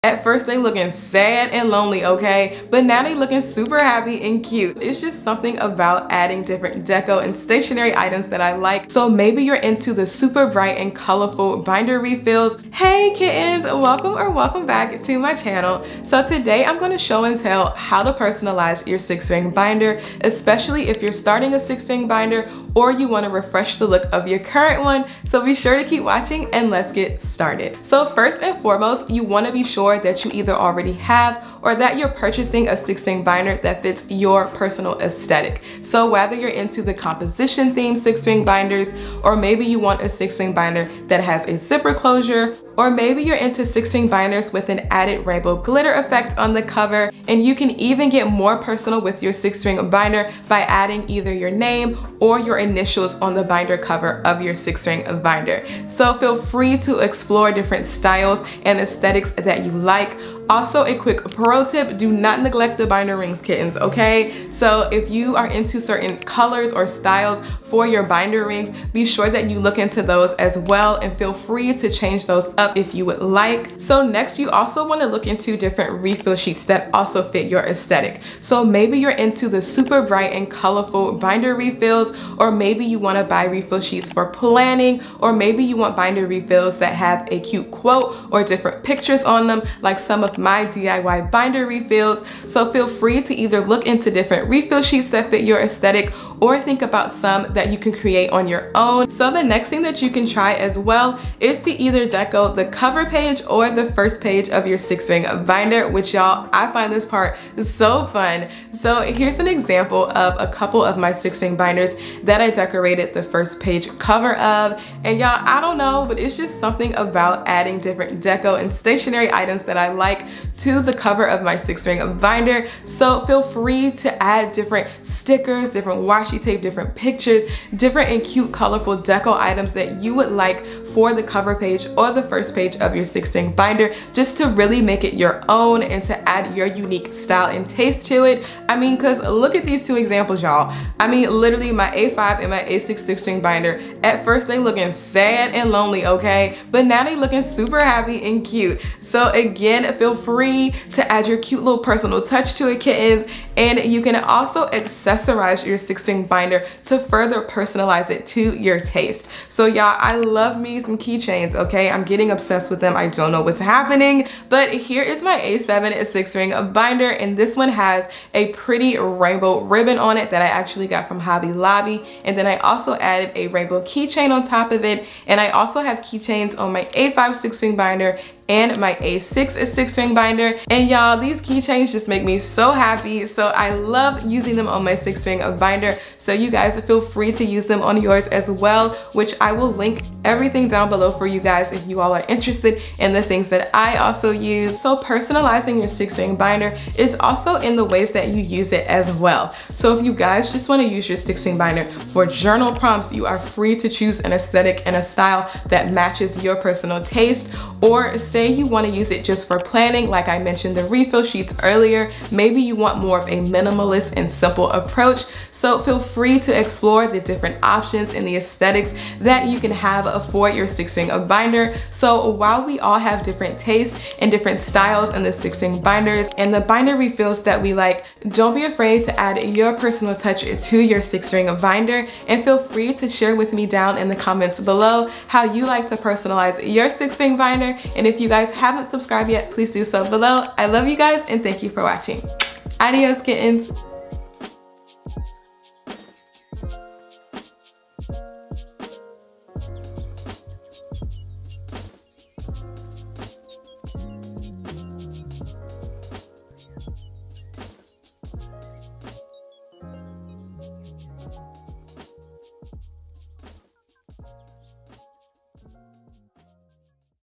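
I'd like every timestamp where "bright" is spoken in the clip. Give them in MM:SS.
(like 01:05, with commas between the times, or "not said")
00:10, 01:20.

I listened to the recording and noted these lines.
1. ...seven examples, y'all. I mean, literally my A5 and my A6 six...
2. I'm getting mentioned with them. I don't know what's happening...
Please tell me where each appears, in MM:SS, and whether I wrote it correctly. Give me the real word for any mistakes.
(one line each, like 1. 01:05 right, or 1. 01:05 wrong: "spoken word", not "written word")
1. 02:19 wrong: "two", not "seven"
2. 02:41 wrong: "obsessed", not "mentioned".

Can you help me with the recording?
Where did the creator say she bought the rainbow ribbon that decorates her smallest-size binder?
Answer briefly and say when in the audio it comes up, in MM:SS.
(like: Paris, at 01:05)
Hobby Lobby, at 02:51.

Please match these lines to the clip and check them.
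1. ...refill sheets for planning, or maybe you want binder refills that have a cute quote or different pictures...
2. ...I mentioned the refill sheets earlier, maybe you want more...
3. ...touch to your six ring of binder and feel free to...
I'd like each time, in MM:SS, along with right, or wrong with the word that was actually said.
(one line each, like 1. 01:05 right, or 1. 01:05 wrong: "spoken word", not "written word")
1. 01:23 right
2. 03:30 right
3. 03:50 right.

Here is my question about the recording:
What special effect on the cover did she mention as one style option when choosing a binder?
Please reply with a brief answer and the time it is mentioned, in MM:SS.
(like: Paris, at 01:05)
Rainbow glitter, at 00:45.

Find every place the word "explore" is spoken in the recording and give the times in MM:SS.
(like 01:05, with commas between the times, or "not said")
00:57, 03:36.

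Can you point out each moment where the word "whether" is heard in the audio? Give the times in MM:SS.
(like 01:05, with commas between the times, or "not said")
00:36.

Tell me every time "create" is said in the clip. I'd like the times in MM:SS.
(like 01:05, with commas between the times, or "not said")
01:37.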